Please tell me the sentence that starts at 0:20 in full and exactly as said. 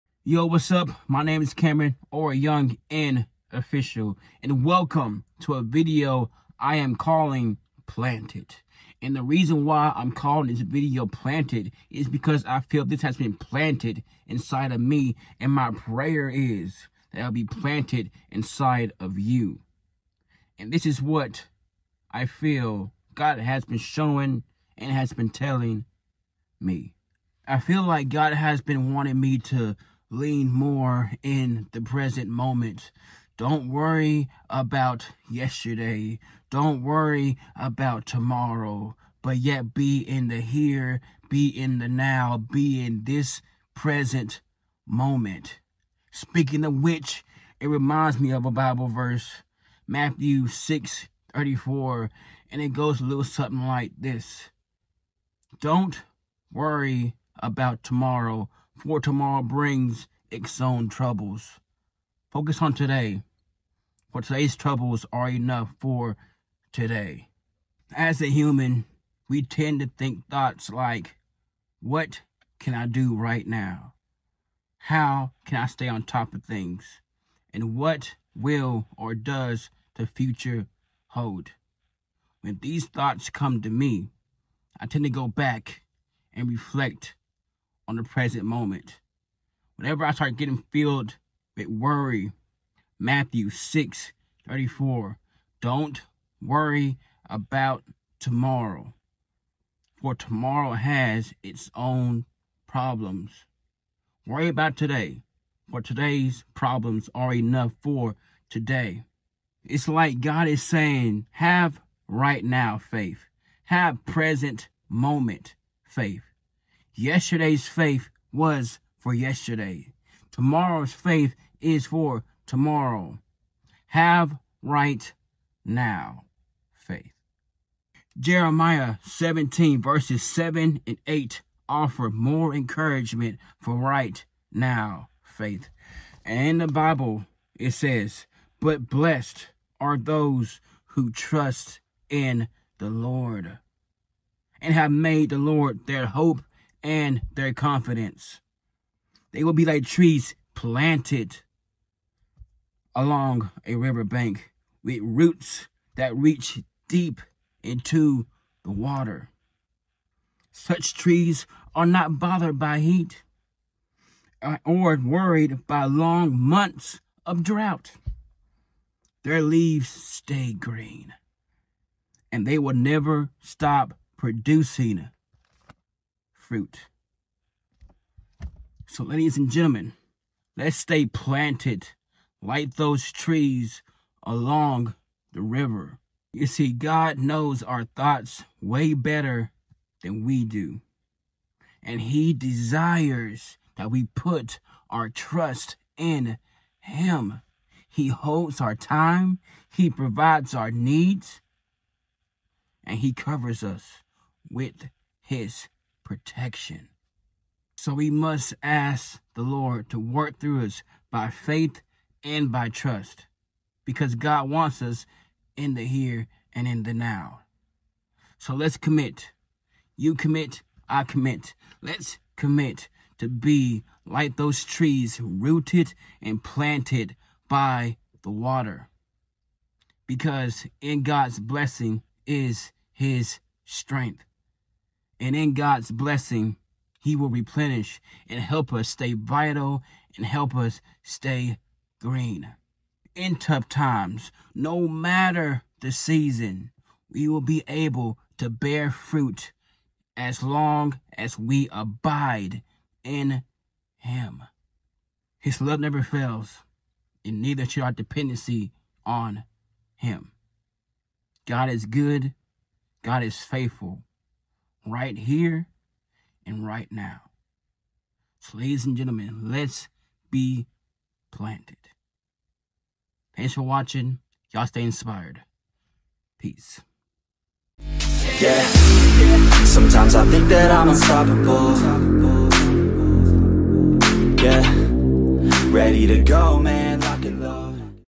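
And this is what I feel God has been showing and has been telling me.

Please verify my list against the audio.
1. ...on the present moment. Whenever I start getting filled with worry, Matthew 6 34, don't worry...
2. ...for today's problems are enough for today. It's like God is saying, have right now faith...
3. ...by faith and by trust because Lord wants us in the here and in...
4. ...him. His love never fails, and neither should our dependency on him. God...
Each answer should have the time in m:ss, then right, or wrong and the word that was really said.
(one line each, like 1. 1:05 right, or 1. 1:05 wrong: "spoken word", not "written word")
1. 1:27 right
2. 1:45 right
3. 3:31 wrong: "God", not "Lord"
4. 4:13 right.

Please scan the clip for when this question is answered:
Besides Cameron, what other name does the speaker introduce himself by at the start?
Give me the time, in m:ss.
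0:02.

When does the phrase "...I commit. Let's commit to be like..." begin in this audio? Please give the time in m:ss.
3:40.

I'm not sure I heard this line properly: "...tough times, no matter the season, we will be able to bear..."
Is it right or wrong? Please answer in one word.
right.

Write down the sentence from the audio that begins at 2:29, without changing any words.
They will be like trees planted along a riverbank with roots that reach deep into the water.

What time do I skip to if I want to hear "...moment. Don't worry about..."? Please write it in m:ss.
0:32.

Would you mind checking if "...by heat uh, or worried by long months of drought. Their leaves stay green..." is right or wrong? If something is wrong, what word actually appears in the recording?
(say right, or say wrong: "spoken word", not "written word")
right.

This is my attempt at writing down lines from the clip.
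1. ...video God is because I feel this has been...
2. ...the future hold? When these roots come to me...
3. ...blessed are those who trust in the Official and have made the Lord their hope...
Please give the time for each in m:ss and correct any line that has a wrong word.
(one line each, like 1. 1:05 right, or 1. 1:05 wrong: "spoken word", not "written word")
1. 0:10 wrong: "Planted", not "God"
2. 1:19 wrong: "thoughts", not "roots"
3. 2:18 wrong: "Lord", not "Official".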